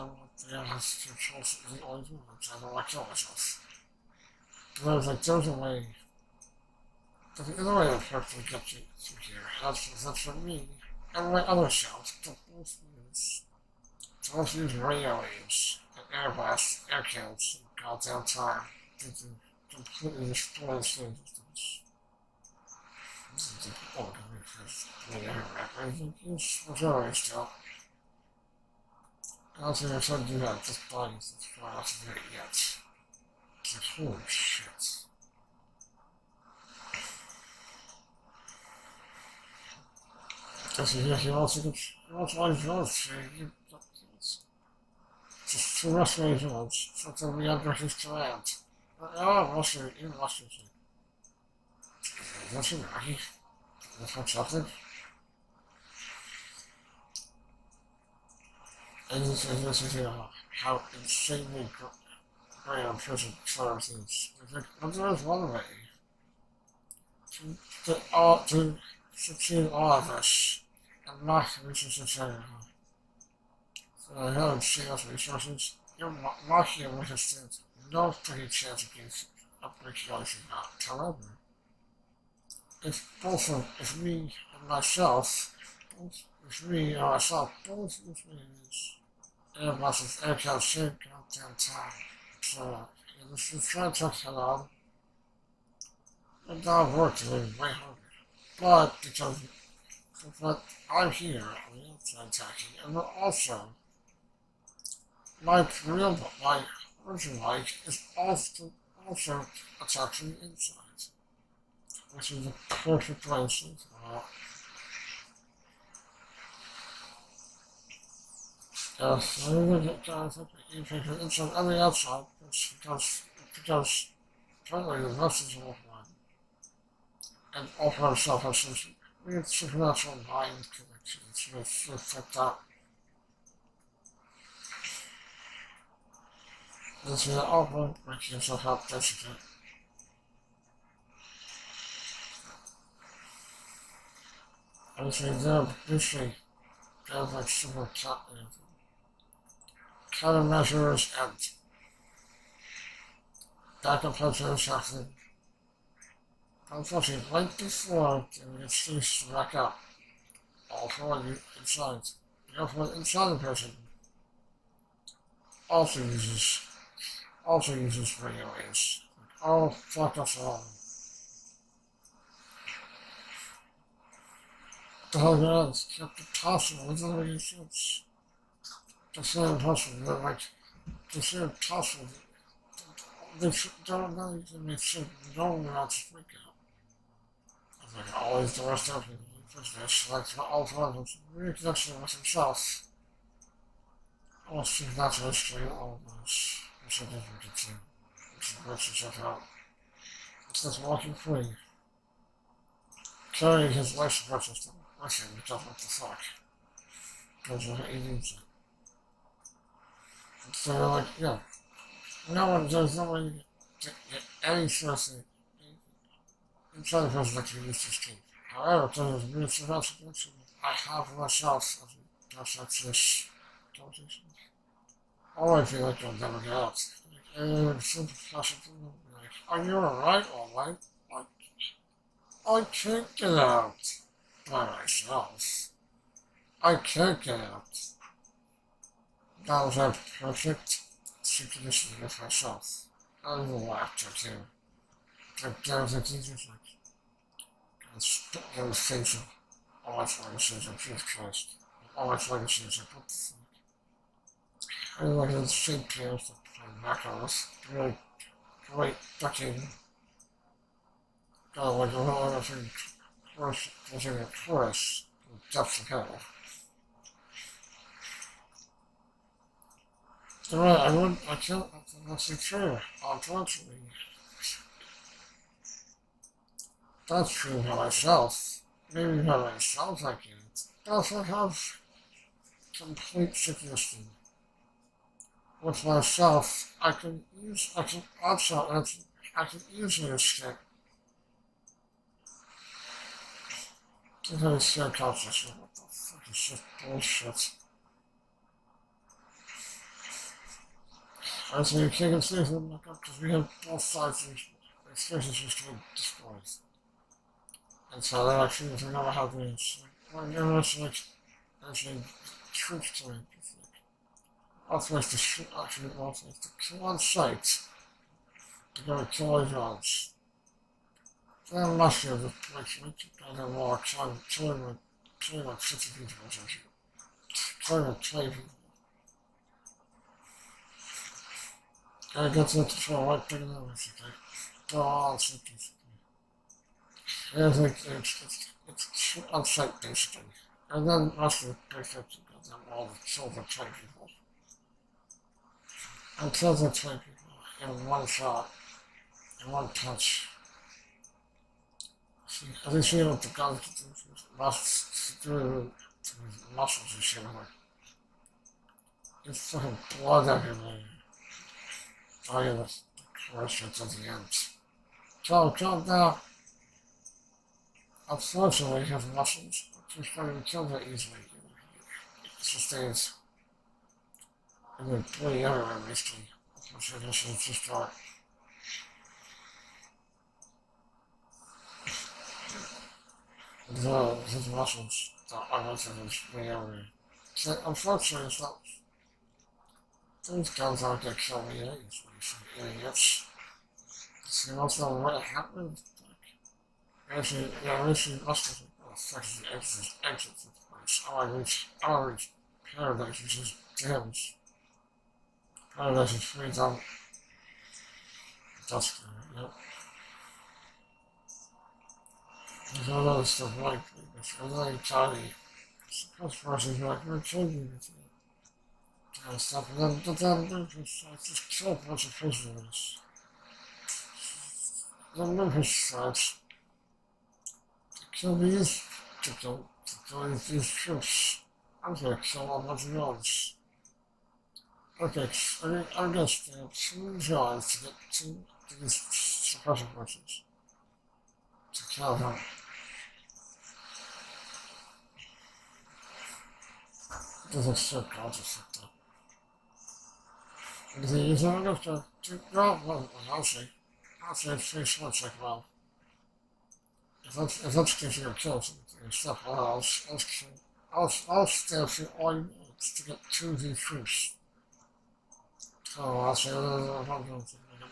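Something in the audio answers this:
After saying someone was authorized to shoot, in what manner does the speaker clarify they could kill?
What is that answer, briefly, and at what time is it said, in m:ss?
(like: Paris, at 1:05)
On sight, at 5:16.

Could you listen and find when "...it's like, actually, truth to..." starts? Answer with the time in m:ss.
5:10.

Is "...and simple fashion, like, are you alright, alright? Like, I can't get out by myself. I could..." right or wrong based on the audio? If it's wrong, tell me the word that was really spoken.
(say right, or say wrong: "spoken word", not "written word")
right.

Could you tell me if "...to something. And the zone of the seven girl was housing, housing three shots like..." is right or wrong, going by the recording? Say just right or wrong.
wrong.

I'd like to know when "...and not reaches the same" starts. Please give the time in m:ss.
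1:11.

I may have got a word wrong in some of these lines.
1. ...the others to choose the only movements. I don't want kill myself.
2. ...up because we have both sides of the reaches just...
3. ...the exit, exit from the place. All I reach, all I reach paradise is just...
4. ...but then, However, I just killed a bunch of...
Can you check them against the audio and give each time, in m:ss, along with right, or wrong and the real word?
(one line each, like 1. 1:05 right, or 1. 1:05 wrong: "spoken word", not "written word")
1. 0:00 right
2. 5:02 wrong: "excuses", not "reaches"
3. 6:39 right
4. 7:00 wrong: "Memphis", not "However".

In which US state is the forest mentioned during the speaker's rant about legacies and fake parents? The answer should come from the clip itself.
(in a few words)
South Dakota.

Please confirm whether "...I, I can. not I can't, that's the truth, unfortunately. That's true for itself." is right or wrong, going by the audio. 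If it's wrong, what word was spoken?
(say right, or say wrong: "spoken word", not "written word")
wrong: "myself", not "itself".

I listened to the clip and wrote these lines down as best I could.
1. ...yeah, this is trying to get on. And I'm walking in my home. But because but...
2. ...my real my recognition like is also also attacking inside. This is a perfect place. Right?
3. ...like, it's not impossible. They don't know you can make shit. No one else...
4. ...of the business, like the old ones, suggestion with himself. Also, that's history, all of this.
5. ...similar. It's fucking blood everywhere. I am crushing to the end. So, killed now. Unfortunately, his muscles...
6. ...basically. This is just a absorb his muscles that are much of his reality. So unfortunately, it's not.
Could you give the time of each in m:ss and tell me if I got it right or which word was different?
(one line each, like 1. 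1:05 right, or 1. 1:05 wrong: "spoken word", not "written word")
1. 1:33 wrong: "working", not "walking"
2. 1:45 wrong: "version", not "recognition"
3. 3:00 right
4. 3:08 wrong: "reconnection", not "suggestion"
5. 5:57 right
6. 6:15 right.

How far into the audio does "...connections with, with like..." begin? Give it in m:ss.
2:10.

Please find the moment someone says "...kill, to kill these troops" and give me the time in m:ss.
7:09.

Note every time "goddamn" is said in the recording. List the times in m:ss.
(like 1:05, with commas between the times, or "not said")
0:17, 1:31.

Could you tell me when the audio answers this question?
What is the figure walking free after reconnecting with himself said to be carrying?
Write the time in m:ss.
3:23.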